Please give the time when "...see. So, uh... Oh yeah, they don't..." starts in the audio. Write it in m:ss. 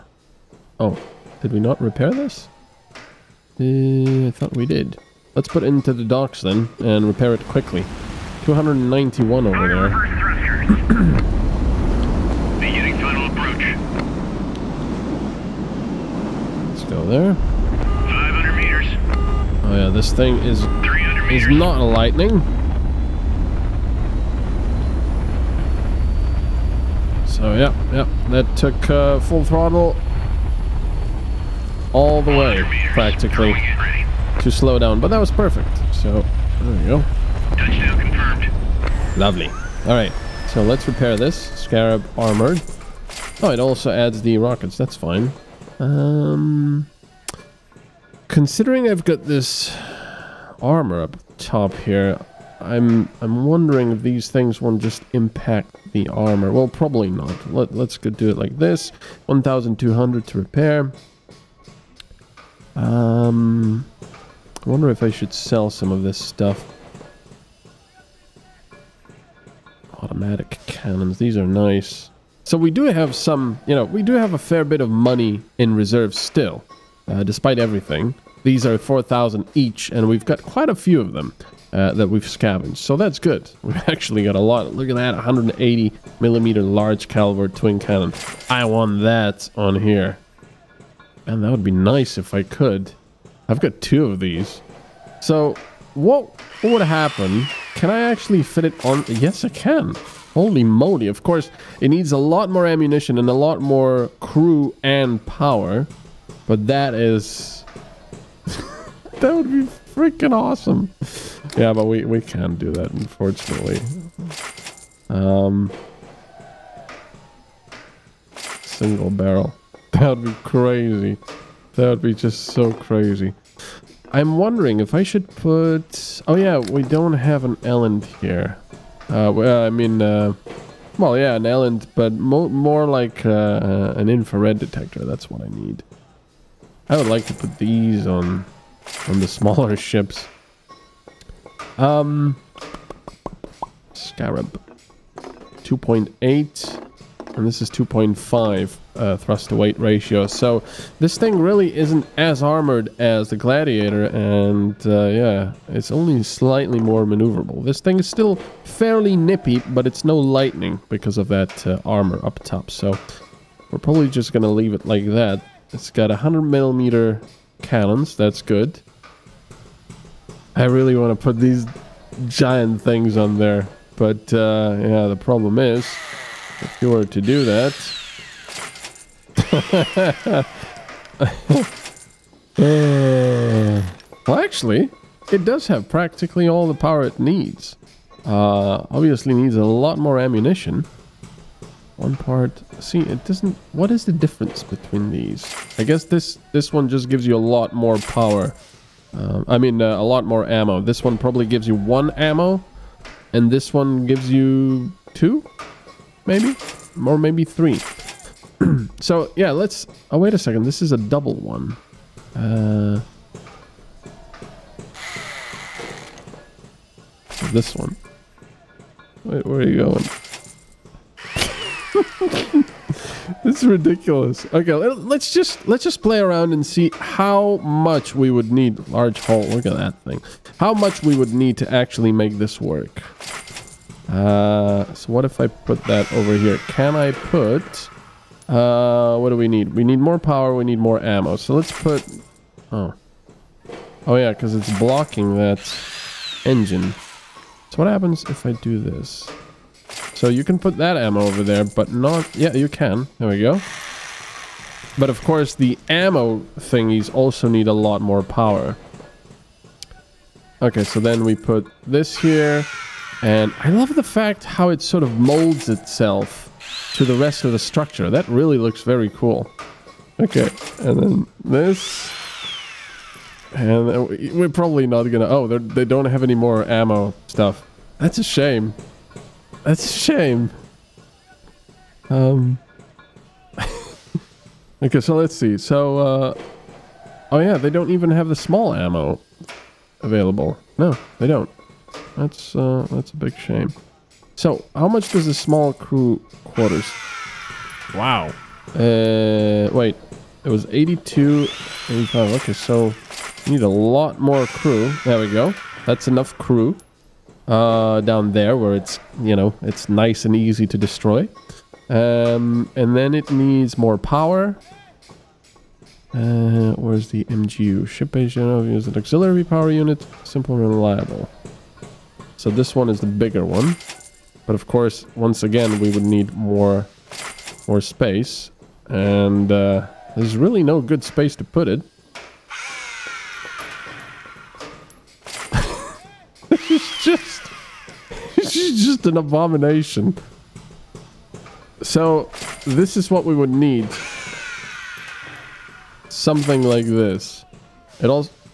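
4:45.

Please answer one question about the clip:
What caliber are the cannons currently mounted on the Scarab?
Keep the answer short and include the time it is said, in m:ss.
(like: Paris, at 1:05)
100 millimeter, at 2:46.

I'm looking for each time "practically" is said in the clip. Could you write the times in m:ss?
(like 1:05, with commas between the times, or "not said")
0:32, 3:05.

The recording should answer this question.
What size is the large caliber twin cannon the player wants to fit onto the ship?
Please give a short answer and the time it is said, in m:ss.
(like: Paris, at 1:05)
180 millimeter, at 1:25.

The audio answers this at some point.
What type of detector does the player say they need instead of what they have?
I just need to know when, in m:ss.
2:14.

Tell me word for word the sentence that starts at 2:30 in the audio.
So this thing really isn't as armored as the Gladiator, and uh, yeah, it's only slightly more maneuverable.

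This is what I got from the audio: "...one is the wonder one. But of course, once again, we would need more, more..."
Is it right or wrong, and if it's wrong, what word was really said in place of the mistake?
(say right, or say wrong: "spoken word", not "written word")
wrong: "bigger", not "wonder".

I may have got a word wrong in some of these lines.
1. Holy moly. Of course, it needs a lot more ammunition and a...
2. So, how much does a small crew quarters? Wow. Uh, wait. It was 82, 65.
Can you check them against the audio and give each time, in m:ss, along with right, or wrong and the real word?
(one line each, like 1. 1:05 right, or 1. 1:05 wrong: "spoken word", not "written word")
1. 1:40 right
2. 4:54 wrong: "85", not "65".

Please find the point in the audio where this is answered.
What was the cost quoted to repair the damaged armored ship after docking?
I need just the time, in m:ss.
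0:59.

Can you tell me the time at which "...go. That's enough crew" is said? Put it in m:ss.
5:05.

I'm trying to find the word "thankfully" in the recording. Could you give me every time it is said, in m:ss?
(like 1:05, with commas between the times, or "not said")
not said.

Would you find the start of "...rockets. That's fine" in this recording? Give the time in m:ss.
0:44.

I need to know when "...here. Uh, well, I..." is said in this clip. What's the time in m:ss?
2:08.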